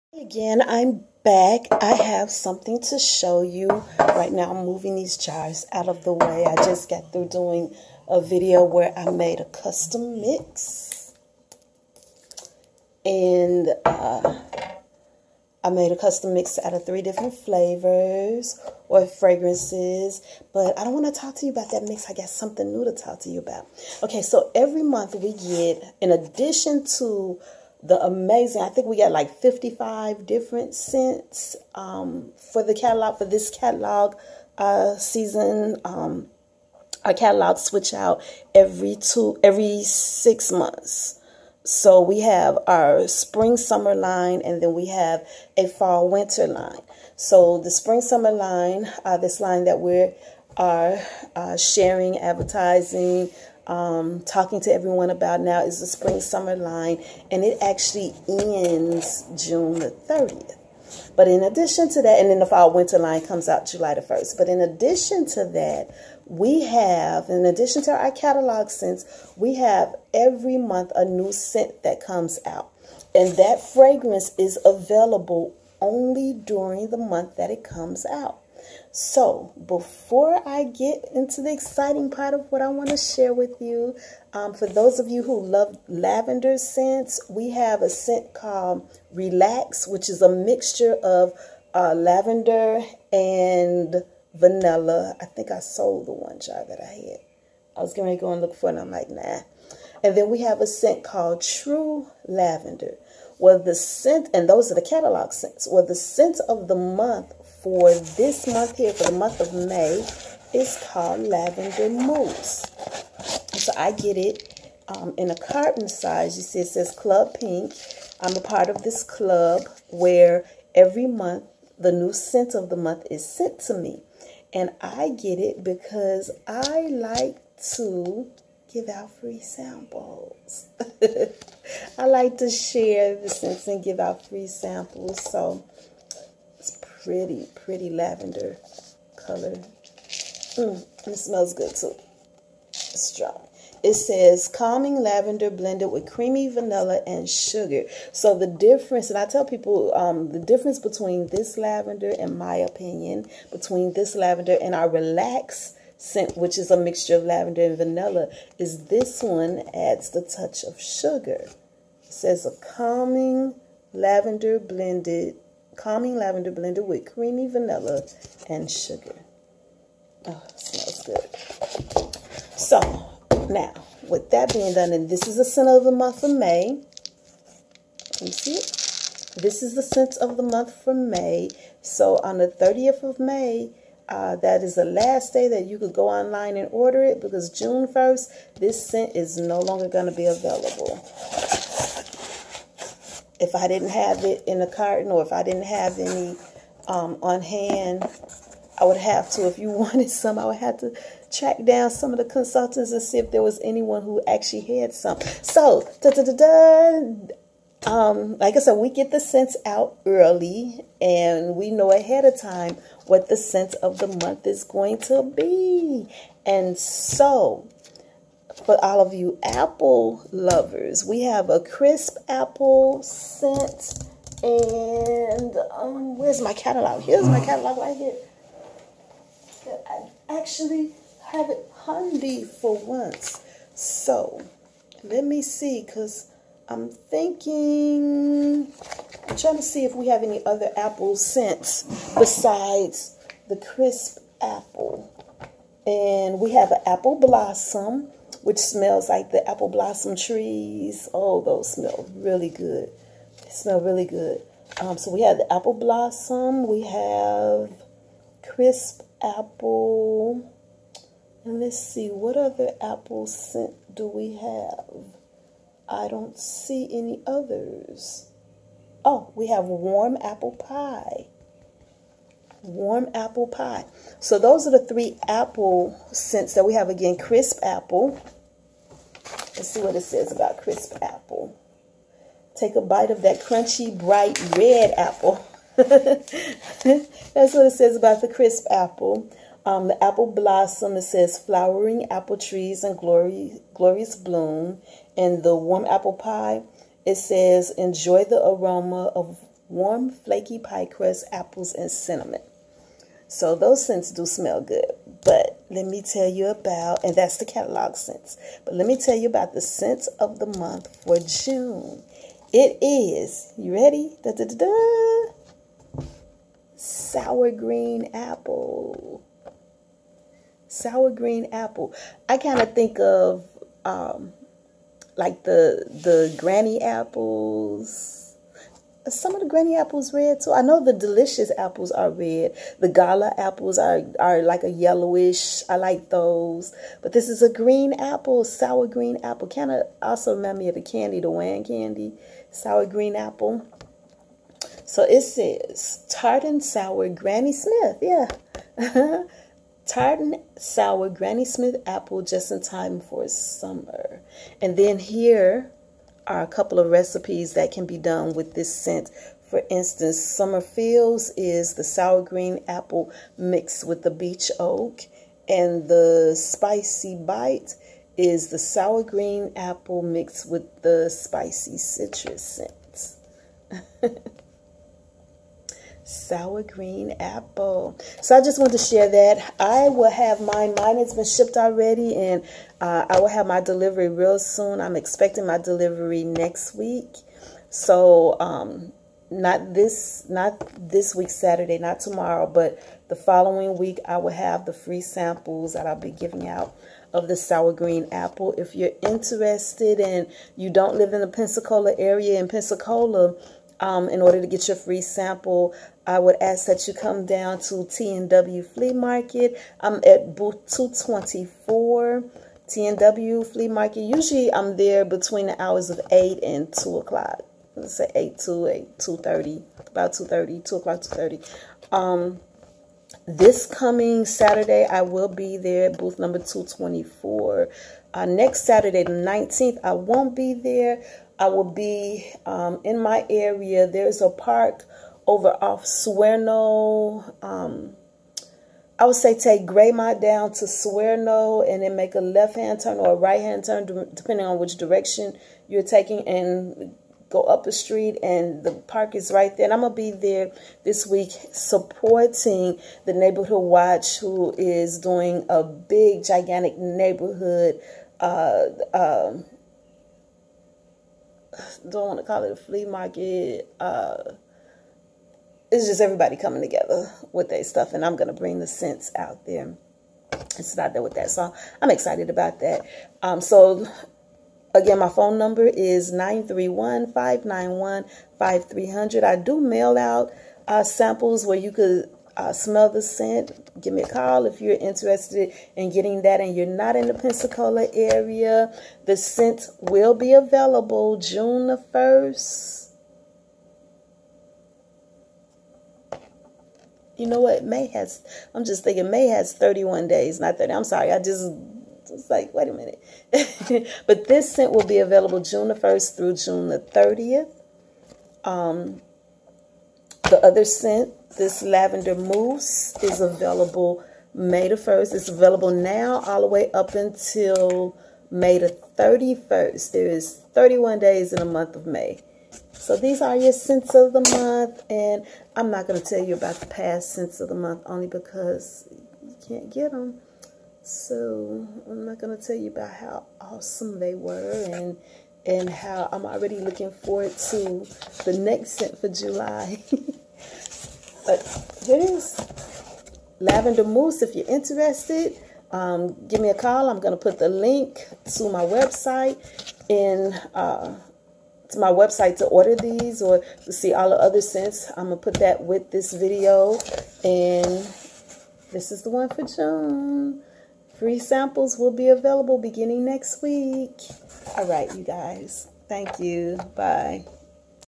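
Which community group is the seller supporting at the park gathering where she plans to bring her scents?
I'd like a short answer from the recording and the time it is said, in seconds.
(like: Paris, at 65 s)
Neighborhood Watch, at 453 s.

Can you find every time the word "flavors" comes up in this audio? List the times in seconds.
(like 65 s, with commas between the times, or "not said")
17 s.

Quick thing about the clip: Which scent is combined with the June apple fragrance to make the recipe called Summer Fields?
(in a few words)
Beech oak.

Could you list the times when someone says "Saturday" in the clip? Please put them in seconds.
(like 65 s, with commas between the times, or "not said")
391 s, 424 s, 428 s.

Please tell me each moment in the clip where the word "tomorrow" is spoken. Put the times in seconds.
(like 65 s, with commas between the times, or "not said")
392 s.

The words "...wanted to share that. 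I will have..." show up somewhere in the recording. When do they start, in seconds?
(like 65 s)
378 s.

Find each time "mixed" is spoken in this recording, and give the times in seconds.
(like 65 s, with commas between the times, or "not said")
363 s, 370 s.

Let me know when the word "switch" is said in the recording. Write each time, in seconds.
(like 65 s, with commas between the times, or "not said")
37 s.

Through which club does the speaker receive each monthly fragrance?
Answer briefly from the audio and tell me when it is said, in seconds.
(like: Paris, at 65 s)
Club Pink, at 116 s.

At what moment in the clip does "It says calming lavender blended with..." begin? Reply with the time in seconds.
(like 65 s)
143 s.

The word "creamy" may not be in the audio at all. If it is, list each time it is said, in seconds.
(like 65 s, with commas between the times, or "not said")
146 s, 167 s.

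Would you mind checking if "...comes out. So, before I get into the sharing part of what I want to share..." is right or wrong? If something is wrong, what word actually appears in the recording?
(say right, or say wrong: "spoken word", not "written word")
wrong: "exciting", not "sharing".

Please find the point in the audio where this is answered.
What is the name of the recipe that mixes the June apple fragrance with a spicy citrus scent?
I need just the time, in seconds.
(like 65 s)
366 s.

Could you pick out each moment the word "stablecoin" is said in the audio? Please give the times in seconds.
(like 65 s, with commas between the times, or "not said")
not said.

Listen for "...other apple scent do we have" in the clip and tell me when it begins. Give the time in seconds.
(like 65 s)
262 s.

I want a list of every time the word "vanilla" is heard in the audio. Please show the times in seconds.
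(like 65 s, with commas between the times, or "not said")
94 s, 146 s, 157 s, 167 s.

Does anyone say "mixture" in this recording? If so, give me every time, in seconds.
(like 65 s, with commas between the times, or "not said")
90 s, 156 s.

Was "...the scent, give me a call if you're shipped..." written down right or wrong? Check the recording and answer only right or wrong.
wrong.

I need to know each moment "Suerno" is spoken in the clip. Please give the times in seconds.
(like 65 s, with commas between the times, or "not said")
435 s, 440 s.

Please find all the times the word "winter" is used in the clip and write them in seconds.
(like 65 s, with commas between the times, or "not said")
46 s, 62 s.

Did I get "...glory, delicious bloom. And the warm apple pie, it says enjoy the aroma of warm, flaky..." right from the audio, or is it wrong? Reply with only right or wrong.
wrong.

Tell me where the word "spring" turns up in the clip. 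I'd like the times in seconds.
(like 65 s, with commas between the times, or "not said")
43 s, 47 s, 55 s.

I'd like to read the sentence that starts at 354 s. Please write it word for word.
And then here are a couple of recipes that can be done with this scent.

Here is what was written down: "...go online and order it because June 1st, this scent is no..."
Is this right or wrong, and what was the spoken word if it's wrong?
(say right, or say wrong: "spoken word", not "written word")
right.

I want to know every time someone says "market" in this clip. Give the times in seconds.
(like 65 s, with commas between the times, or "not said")
408 s, 413 s, 462 s.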